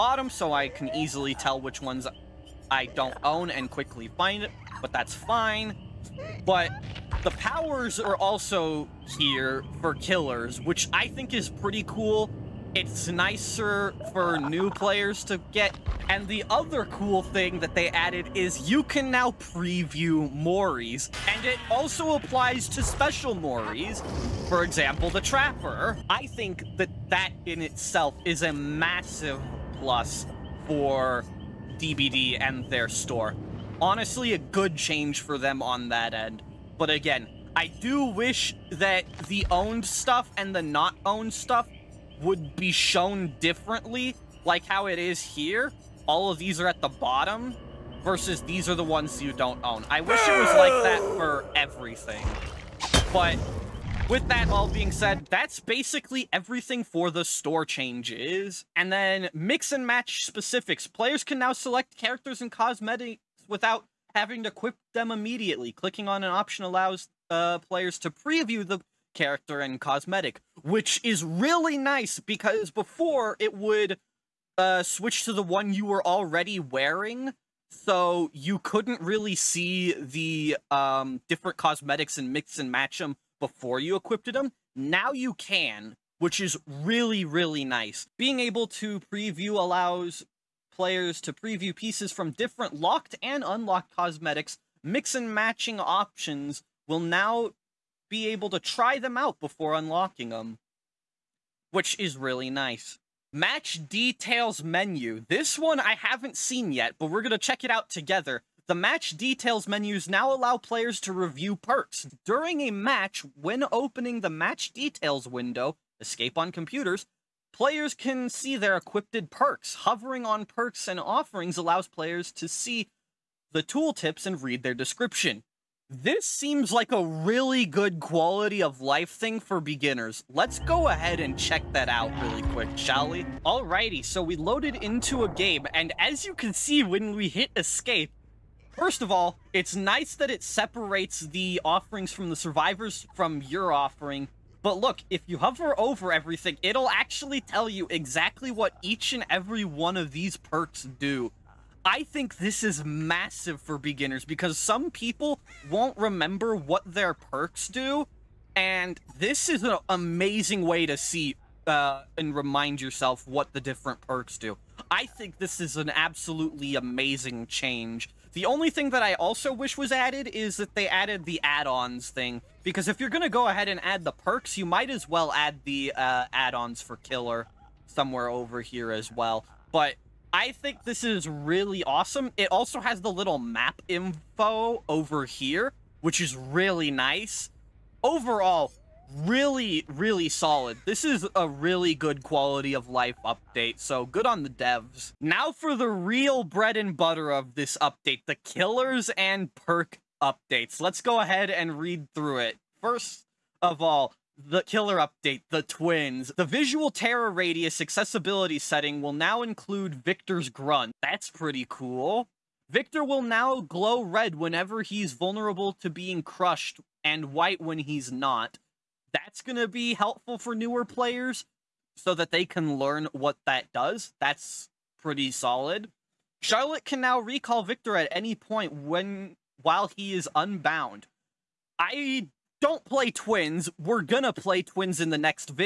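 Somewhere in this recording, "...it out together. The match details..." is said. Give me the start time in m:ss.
1:47.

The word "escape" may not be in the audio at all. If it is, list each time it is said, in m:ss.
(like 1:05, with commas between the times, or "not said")
1:56, 2:17.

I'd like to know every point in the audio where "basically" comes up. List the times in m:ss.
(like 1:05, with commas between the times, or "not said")
0:55.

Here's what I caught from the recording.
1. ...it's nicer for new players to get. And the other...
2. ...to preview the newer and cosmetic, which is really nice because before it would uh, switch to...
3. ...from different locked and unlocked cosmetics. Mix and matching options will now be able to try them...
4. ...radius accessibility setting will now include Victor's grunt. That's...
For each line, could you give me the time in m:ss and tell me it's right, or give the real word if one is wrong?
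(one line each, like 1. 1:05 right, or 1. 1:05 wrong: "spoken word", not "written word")
1. 0:12 right
2. 1:07 wrong: "character", not "newer"
3. 1:32 right
4. 3:27 right.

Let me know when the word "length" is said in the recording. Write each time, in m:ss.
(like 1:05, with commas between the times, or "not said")
not said.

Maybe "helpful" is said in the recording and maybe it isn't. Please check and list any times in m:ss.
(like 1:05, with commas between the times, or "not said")
3:39.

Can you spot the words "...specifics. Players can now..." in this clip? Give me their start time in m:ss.
1:00.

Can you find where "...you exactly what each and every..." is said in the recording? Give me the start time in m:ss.
2:27.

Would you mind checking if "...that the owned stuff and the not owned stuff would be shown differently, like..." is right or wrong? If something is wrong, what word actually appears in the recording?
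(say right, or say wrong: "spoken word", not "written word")
right.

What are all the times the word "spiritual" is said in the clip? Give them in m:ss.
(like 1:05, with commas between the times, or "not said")
not said.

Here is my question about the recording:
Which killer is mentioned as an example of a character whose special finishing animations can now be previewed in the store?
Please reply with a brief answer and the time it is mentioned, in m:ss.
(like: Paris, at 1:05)
Trapper, at 0:25.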